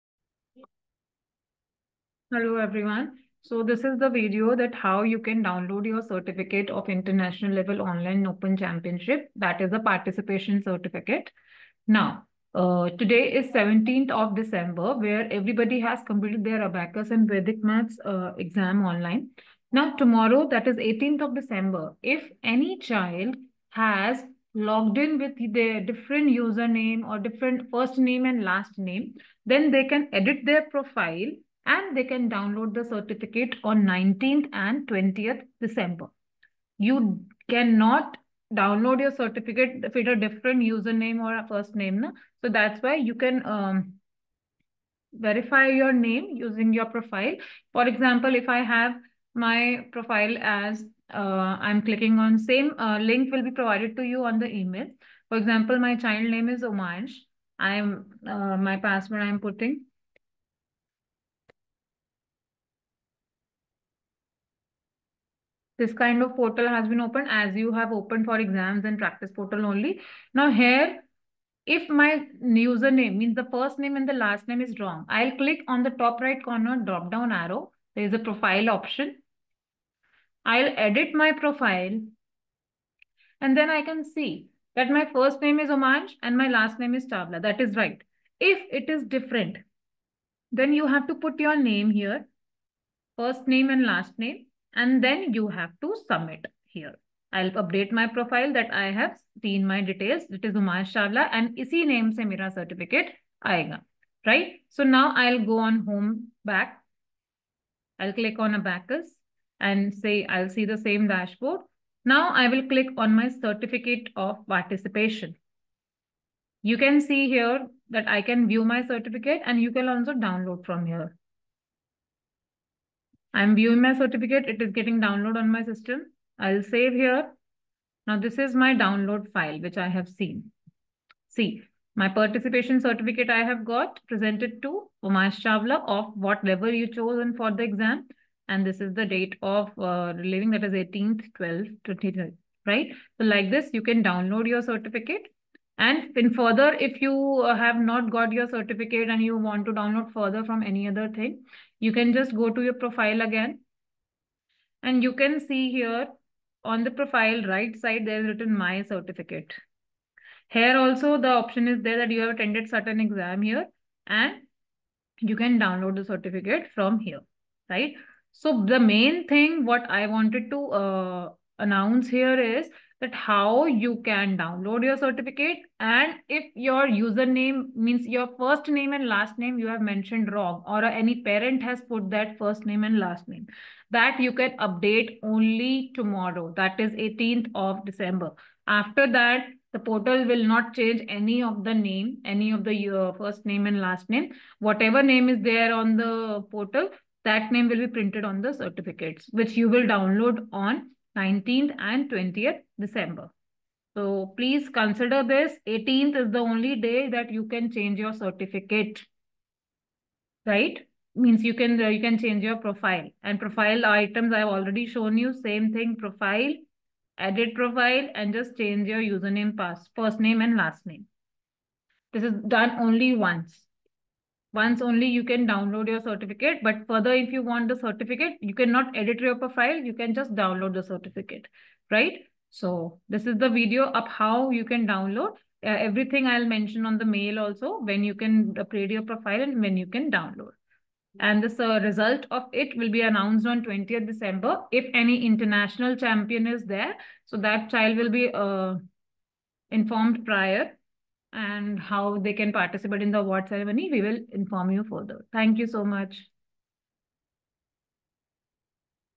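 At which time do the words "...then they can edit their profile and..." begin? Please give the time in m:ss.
0:29.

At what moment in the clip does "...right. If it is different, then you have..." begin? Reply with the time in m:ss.
1:27.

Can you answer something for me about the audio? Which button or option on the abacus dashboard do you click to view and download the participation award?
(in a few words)
My certificate of participation.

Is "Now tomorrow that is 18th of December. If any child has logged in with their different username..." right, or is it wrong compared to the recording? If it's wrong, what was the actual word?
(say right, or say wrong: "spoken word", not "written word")
right.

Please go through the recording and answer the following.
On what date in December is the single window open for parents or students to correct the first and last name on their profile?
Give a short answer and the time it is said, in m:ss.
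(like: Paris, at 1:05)
18th December, at 3:25.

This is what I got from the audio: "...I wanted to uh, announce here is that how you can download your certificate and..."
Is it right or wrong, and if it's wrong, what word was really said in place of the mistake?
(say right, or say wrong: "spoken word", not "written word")
right.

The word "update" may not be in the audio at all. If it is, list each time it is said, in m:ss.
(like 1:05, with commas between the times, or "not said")
1:37, 3:04.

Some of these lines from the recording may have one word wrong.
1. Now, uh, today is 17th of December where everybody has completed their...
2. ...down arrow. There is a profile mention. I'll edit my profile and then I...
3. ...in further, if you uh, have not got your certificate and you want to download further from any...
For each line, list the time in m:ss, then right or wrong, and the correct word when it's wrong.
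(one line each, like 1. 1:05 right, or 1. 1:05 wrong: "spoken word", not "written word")
1. 0:11 right
2. 1:17 wrong: "option", not "mention"
3. 2:26 right.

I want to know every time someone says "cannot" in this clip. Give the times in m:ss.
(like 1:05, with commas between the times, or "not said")
0:37, 3:48.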